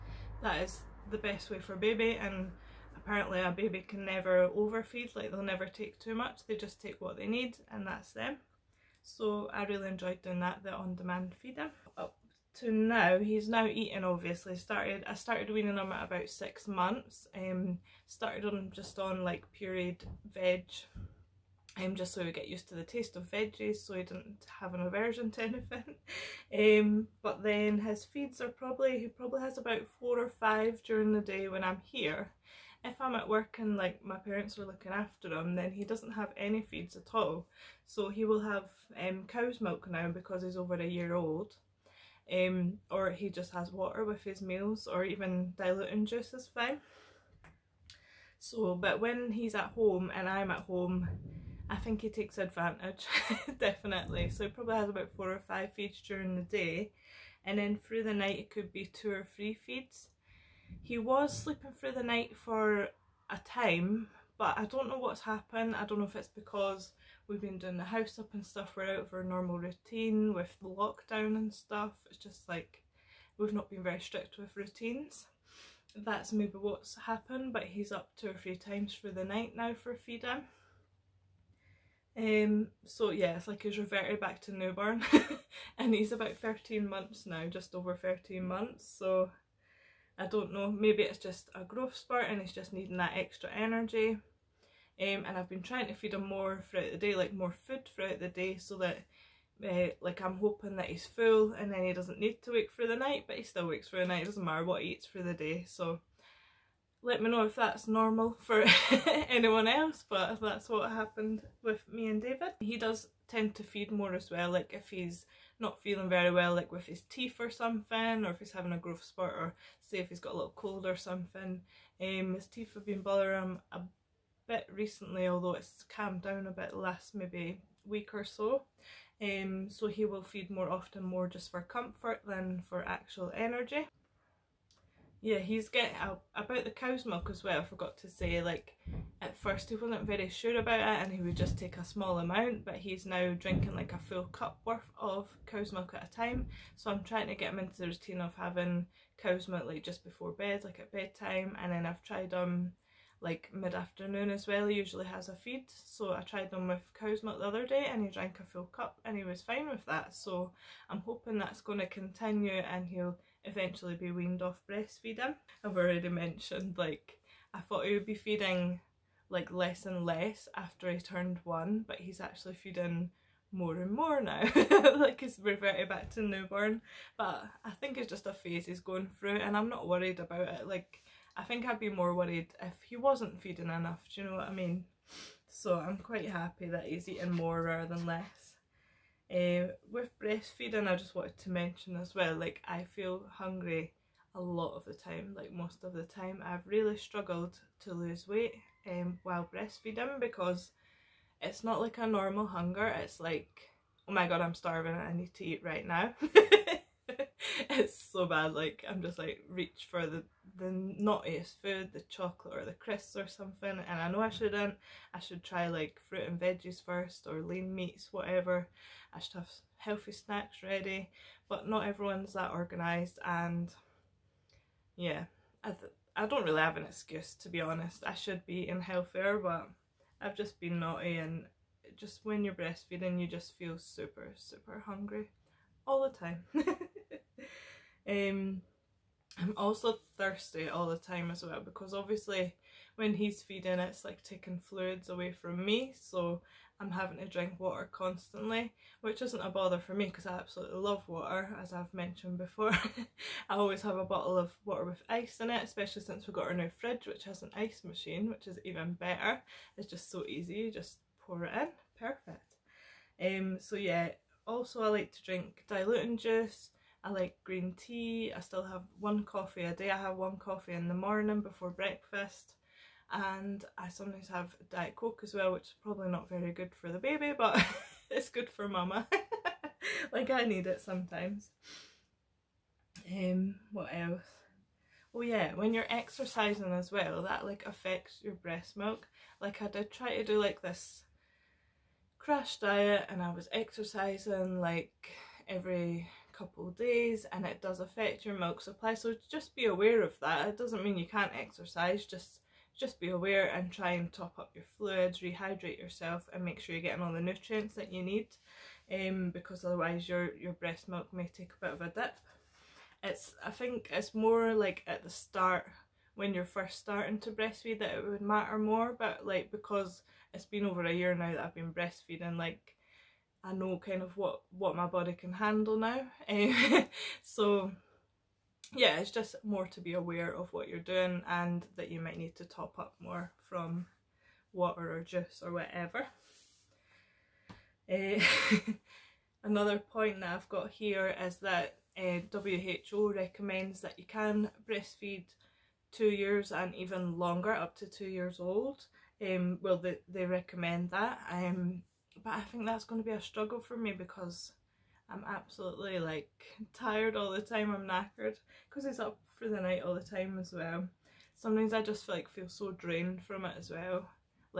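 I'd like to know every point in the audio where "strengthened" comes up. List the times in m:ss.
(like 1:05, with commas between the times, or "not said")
not said.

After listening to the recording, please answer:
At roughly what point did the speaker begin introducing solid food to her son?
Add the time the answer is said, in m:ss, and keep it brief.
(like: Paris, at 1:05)
6 months, at 0:16.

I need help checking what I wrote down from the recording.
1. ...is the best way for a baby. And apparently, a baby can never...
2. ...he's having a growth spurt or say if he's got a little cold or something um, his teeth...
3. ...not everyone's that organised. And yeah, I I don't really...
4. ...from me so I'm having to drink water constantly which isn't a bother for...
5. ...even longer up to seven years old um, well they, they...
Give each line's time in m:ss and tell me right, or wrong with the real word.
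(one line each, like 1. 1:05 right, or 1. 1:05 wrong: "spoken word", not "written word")
1. 0:00 right
2. 1:58 right
3. 3:41 right
4. 4:05 right
5. 5:46 wrong: "two", not "seven".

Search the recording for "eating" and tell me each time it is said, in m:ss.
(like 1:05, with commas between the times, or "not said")
0:13, 3:07, 3:48.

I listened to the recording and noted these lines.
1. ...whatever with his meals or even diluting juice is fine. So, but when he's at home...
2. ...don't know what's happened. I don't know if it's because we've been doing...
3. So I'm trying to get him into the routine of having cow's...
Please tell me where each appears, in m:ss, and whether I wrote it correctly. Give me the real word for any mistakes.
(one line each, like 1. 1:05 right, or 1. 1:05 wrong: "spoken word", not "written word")
1. 0:43 wrong: "water", not "whatever"
2. 1:04 right
3. 2:26 right.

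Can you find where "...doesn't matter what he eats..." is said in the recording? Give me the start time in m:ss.
1:44.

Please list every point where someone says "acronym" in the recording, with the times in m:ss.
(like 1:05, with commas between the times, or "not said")
not said.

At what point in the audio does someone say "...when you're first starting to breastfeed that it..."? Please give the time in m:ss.
5:16.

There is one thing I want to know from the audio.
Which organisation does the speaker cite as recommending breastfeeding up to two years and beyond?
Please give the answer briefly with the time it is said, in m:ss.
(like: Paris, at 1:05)
WHO, at 5:42.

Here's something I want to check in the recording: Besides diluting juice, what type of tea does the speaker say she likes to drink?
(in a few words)
Green tea.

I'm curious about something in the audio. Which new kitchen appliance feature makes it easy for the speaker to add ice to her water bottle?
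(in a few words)
Ice machine.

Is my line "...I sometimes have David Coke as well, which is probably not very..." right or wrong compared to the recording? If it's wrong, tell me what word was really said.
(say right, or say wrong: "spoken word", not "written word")
wrong: "Diet", not "David".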